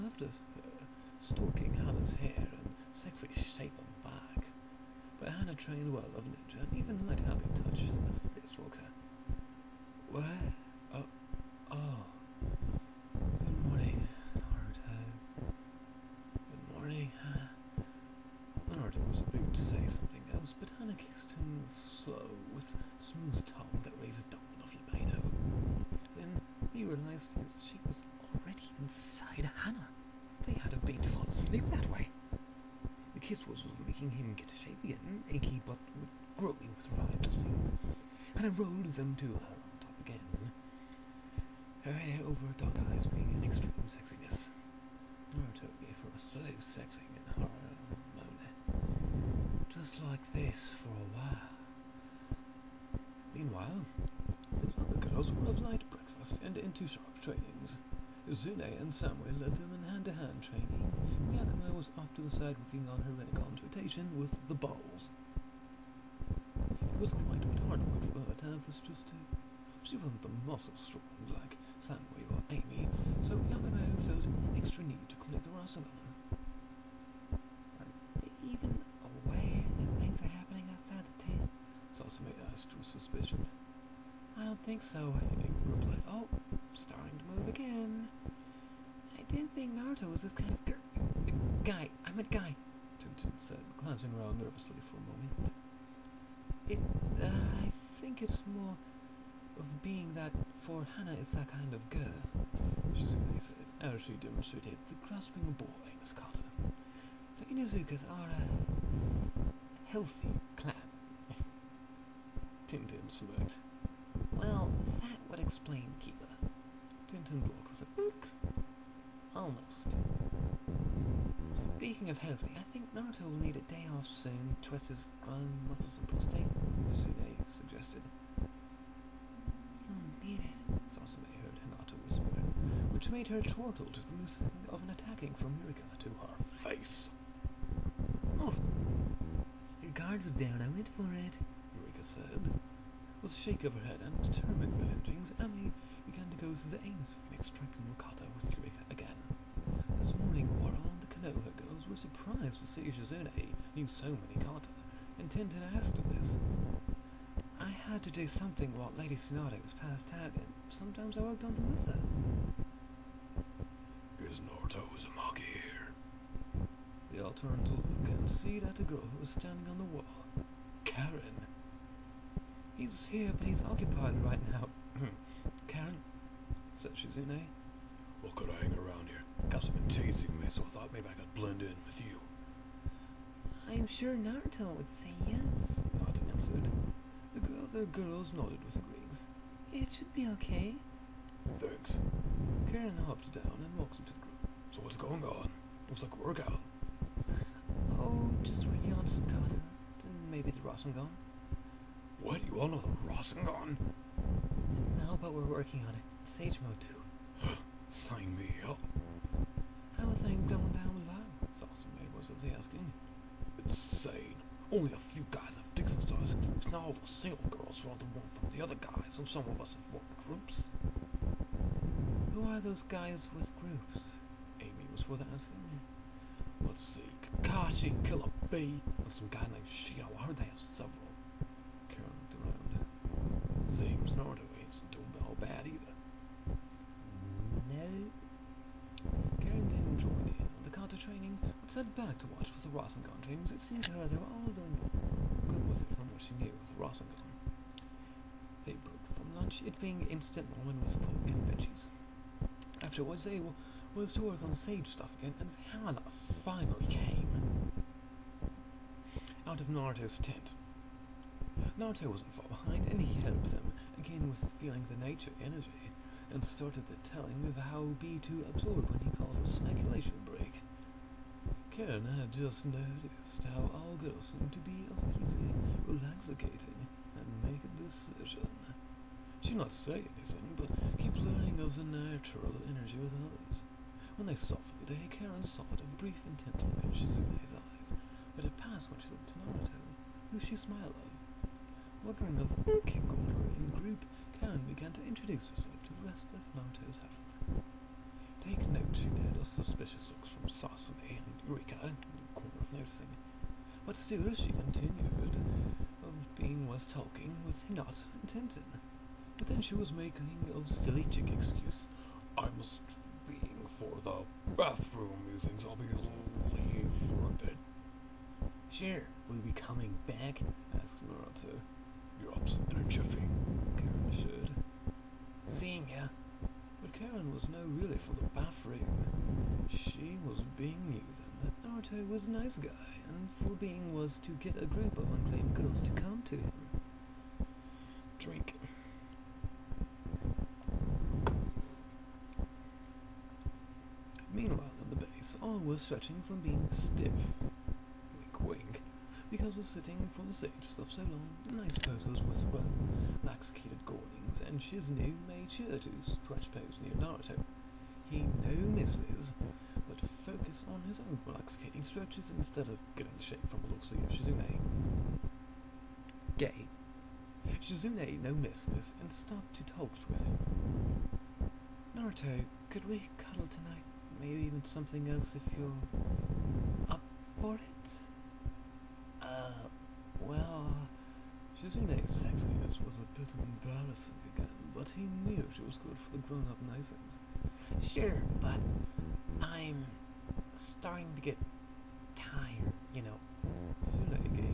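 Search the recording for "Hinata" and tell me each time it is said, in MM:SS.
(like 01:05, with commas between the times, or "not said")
02:11, 05:07.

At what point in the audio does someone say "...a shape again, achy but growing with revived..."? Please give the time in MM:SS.
00:34.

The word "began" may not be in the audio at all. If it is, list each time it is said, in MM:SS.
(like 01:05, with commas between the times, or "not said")
02:26, 04:54.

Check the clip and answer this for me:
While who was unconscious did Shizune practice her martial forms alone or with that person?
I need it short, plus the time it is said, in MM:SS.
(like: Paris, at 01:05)
Lady Tsunade, at 02:38.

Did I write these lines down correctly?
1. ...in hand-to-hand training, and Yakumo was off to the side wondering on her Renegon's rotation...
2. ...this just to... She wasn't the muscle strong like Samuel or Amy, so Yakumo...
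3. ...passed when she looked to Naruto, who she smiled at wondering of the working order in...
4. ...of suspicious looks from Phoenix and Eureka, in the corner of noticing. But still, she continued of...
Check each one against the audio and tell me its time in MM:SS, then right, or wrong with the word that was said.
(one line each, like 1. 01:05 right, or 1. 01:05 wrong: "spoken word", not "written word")
1. 00:59 wrong: "working", not "wondering"
2. 01:08 right
3. 04:48 right
4. 04:59 wrong: "Sasumi", not "Phoenix".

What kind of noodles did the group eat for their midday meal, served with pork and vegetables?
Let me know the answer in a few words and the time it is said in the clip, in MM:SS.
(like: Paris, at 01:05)
Instant ramen, at 04:10.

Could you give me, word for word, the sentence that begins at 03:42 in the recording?
Who are those guys with groups?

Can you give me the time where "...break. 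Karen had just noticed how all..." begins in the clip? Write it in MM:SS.
04:30.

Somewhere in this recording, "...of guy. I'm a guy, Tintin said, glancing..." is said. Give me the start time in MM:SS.
01:30.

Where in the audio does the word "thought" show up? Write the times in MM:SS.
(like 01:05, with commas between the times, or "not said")
03:00.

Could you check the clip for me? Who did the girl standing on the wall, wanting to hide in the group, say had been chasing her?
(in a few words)
Gus.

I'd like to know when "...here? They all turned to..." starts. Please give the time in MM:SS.
02:45.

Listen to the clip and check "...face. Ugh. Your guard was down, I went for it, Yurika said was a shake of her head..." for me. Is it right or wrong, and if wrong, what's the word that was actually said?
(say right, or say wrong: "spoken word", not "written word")
right.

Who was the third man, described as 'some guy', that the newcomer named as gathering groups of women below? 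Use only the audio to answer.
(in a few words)
Shino.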